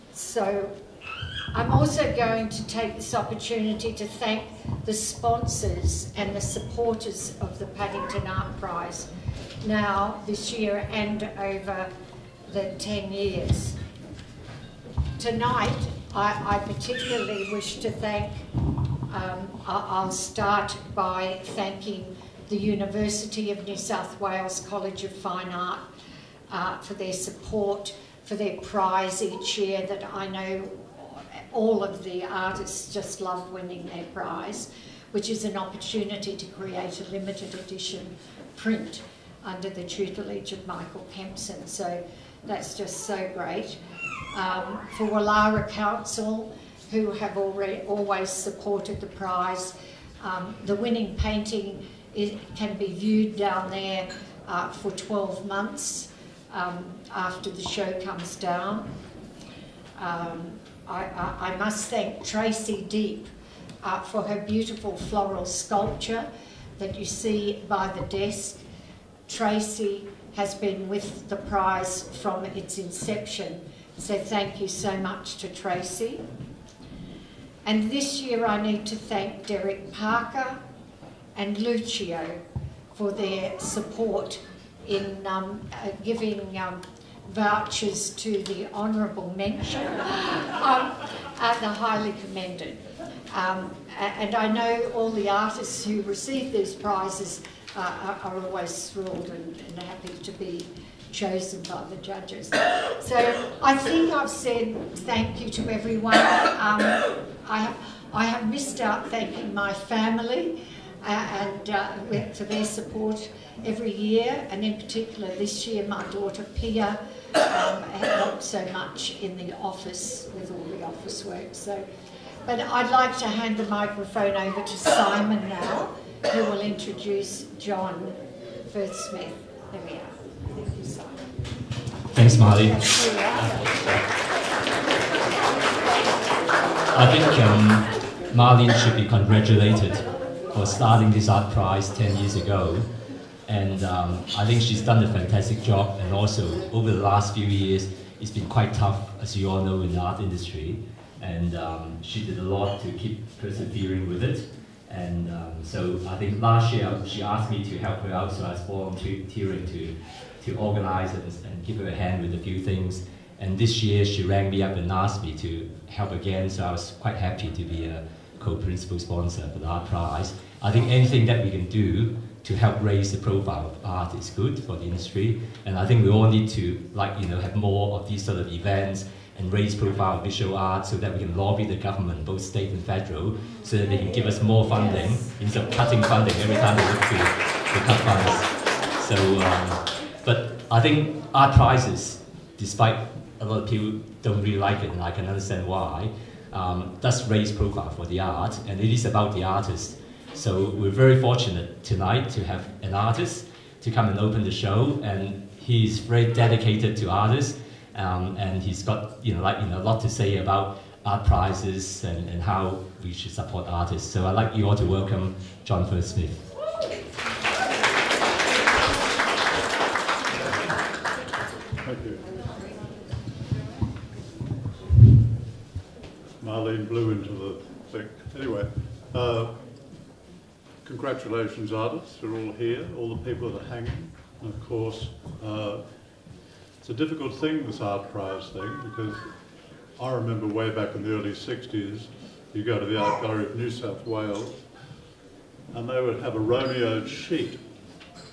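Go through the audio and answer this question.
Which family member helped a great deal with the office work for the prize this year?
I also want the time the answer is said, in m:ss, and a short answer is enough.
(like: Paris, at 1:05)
Pia, at 1:56.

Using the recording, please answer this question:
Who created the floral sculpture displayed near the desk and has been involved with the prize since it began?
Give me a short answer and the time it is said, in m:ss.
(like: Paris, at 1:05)
Tracey Deep, at 1:02.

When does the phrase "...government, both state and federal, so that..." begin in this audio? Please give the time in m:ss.
3:01.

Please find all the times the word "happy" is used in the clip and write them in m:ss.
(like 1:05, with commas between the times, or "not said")
1:39, 2:47.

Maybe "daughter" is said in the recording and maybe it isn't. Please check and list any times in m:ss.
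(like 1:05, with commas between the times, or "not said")
1:56.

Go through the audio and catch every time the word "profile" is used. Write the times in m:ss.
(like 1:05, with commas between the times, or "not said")
2:53, 2:59, 3:17.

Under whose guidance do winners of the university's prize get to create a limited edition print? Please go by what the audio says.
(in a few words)
Michael Kempson.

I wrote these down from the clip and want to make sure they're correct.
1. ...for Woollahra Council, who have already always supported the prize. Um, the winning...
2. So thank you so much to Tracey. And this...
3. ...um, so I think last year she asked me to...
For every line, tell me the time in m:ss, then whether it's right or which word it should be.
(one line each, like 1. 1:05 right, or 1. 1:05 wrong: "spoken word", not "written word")
1. 0:44 right
2. 1:13 right
3. 2:35 right.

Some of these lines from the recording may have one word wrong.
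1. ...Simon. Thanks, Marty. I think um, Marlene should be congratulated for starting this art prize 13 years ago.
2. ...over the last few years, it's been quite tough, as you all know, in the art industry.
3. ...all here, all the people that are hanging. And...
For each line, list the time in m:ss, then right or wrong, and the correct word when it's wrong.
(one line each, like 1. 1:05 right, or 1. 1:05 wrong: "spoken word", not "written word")
1. 2:10 wrong: "10", not "13"
2. 2:26 right
3. 3:52 right.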